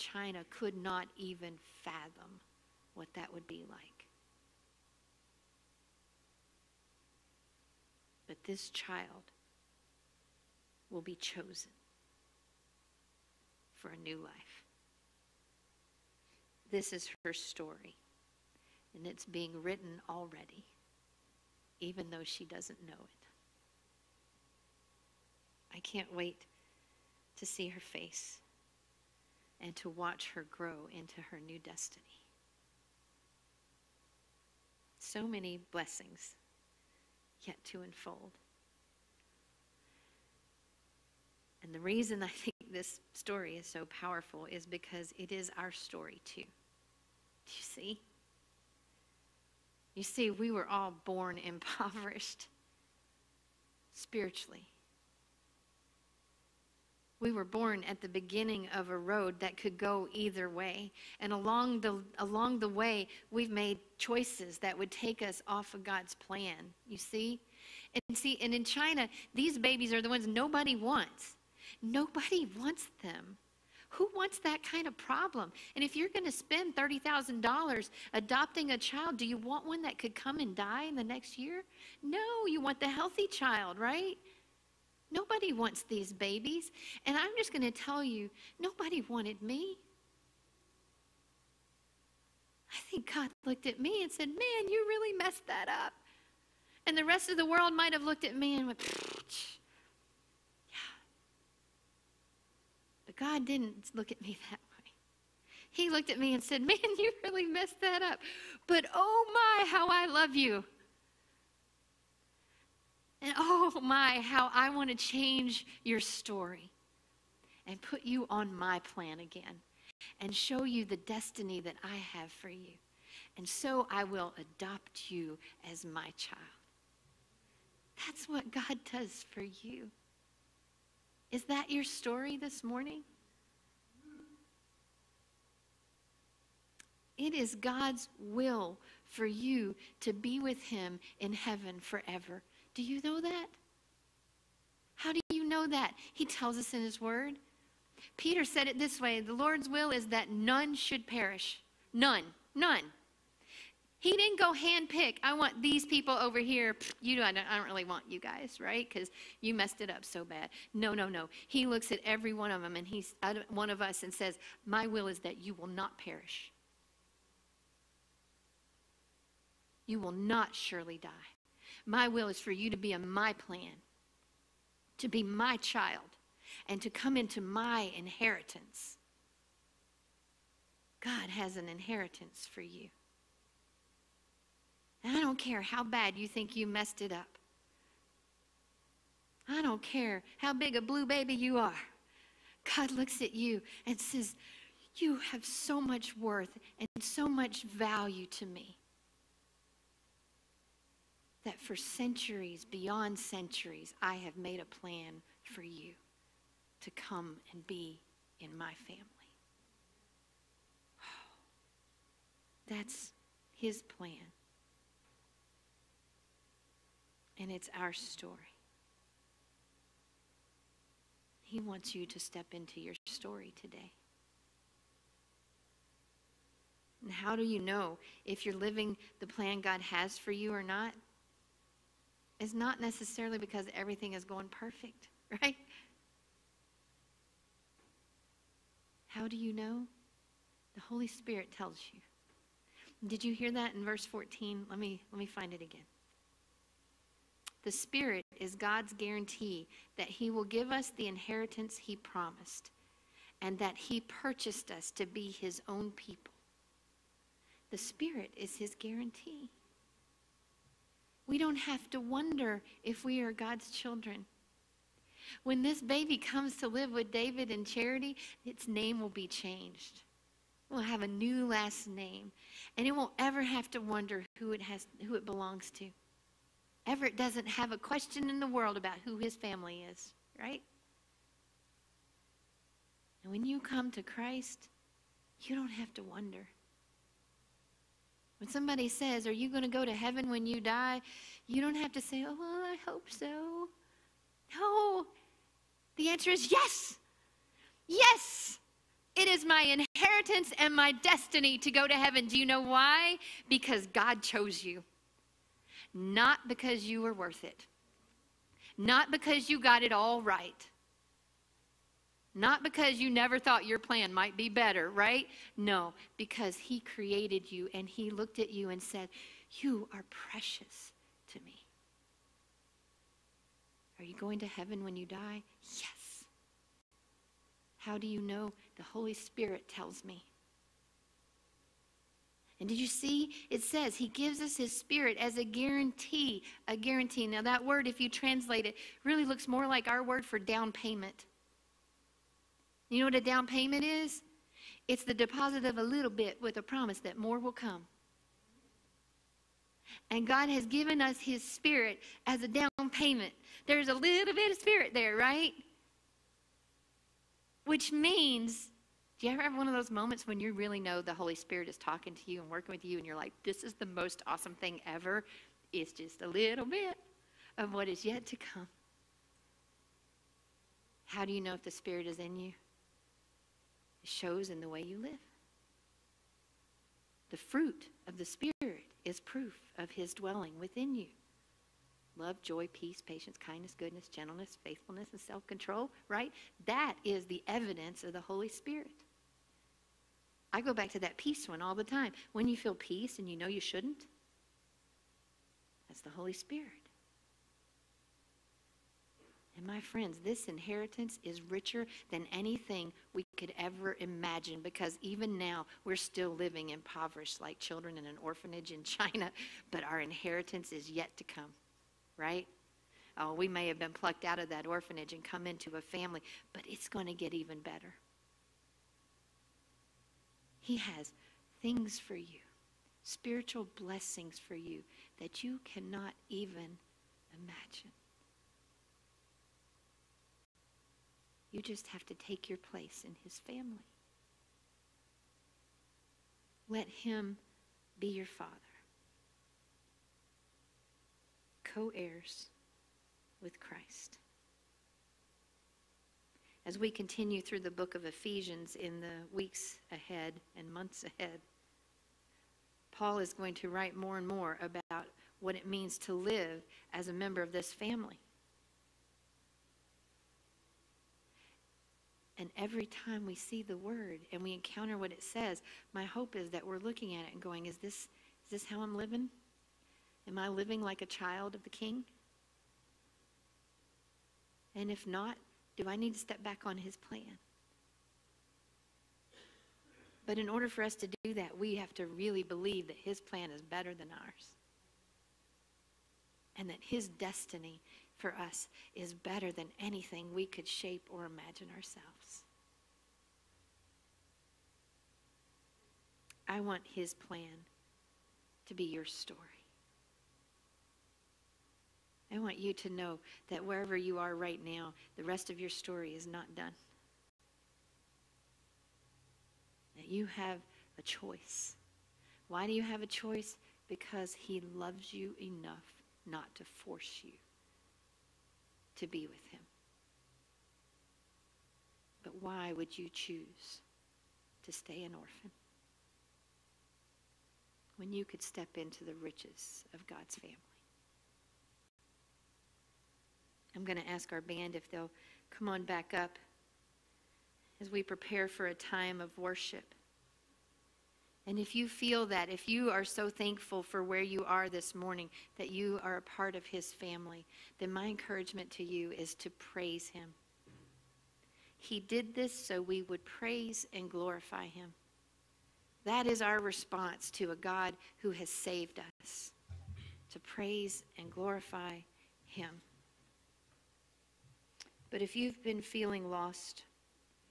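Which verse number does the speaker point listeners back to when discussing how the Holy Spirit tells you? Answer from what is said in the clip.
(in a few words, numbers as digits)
14.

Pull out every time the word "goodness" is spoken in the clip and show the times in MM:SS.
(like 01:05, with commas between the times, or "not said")
06:23.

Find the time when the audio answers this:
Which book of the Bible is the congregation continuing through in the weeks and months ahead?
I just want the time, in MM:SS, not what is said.
07:28.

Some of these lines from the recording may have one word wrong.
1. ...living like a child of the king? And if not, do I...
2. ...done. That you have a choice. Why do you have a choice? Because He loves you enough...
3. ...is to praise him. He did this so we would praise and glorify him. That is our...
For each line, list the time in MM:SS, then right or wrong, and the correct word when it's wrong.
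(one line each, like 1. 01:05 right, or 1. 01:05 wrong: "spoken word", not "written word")
1. 07:50 right
2. 08:26 right
3. 09:09 right.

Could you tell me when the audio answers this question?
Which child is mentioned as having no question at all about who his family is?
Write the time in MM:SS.
04:36.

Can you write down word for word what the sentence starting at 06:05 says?
It's just a little bit of what is yet to come.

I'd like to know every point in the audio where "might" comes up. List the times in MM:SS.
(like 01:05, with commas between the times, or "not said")
01:37, 05:14.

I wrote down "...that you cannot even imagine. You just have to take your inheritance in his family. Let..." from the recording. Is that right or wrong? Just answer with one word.
wrong.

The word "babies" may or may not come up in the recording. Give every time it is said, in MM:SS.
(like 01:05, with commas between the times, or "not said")
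01:09, 01:26.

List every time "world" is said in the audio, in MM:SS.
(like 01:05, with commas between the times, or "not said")
01:37, 04:38.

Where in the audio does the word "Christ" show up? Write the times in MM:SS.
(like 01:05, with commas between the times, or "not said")
04:44, 07:23.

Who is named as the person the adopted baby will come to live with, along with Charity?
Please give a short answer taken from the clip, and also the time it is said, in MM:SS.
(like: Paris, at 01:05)
David, at 04:27.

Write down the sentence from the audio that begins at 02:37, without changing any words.
You know, I don't, I don't really want you guys, right?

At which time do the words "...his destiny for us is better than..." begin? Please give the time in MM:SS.
08:06.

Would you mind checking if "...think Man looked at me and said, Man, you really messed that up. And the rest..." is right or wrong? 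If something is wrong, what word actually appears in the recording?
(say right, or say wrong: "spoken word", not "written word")
wrong: "God", not "Man".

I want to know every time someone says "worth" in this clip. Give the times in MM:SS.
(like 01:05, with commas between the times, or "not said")
03:16, 05:07.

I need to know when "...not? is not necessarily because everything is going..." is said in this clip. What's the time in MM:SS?
03:50.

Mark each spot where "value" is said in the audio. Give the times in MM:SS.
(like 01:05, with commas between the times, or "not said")
03:17.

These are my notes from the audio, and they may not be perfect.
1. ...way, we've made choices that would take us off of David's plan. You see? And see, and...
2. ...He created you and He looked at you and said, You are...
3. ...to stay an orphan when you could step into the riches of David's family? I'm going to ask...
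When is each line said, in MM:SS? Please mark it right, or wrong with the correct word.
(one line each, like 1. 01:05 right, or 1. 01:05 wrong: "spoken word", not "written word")
1. 01:02 wrong: "God", not "David"
2. 05:16 right
3. 08:44 wrong: "God", not "David".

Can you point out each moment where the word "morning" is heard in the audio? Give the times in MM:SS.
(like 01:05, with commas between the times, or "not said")
02:12, 09:04.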